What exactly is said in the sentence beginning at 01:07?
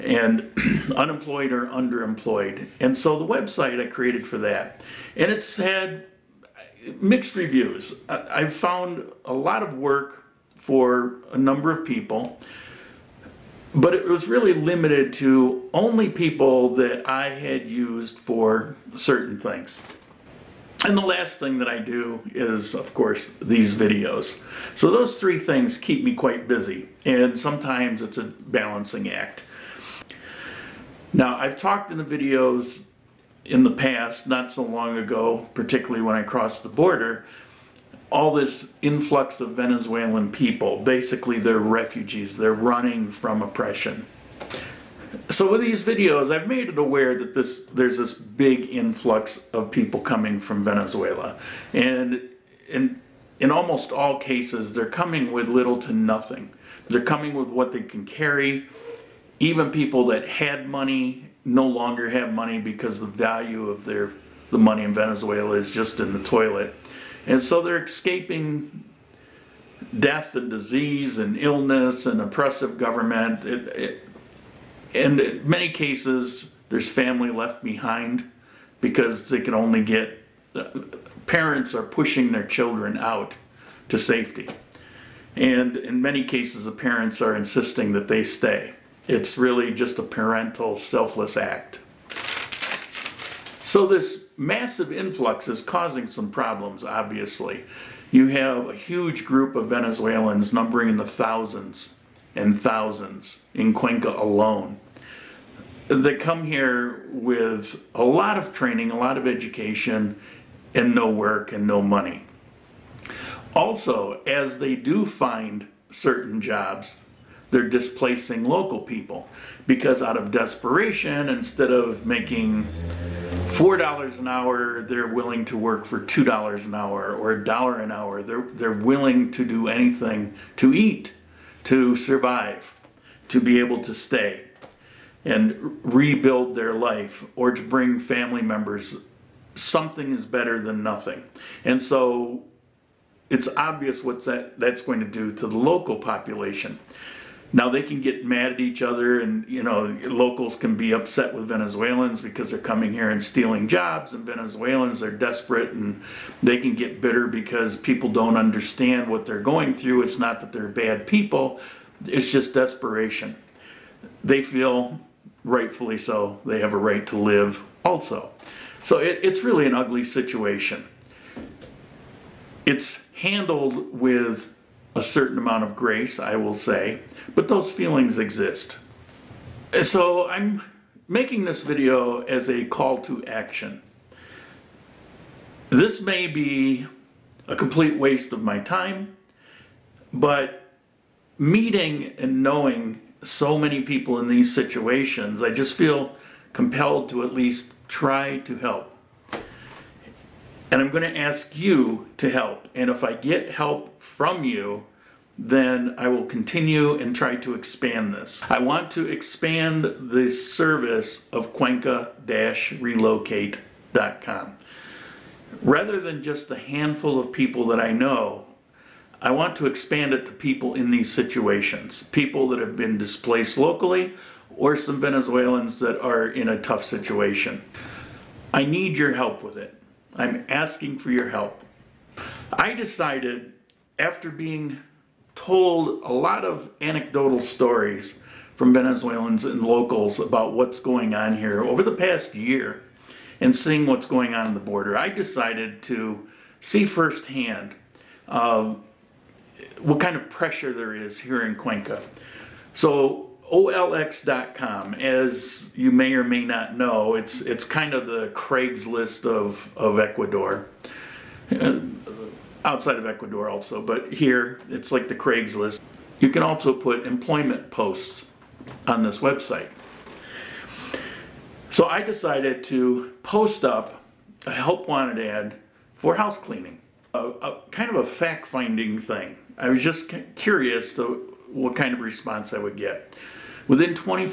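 And so they're escaping death and disease and illness and oppressive government.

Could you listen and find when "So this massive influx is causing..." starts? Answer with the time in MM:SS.
01:33.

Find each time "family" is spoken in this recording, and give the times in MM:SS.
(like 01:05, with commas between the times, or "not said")
01:16, 02:18.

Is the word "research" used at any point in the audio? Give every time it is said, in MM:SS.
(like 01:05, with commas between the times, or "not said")
not said.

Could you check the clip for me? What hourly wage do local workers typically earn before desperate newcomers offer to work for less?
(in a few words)
$4.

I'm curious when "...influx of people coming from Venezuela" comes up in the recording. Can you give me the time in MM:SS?
00:48.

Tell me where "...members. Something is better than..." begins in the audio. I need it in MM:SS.
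02:18.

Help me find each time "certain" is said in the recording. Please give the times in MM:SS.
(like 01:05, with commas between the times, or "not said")
00:18, 01:55, 02:55.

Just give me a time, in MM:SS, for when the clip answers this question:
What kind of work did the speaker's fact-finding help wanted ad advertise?
04:36.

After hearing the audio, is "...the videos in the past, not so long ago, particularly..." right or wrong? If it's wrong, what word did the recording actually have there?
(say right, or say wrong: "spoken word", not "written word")
right.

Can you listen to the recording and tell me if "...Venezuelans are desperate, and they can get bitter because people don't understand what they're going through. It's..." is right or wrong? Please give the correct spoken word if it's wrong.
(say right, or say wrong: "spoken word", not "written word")
right.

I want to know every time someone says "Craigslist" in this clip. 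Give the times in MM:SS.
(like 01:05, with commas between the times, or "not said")
04:18, 04:25.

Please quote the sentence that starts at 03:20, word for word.
And I'm going to ask you to help.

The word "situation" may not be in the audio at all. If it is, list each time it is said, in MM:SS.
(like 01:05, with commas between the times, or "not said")
02:50, 03:14, 03:41, 03:46.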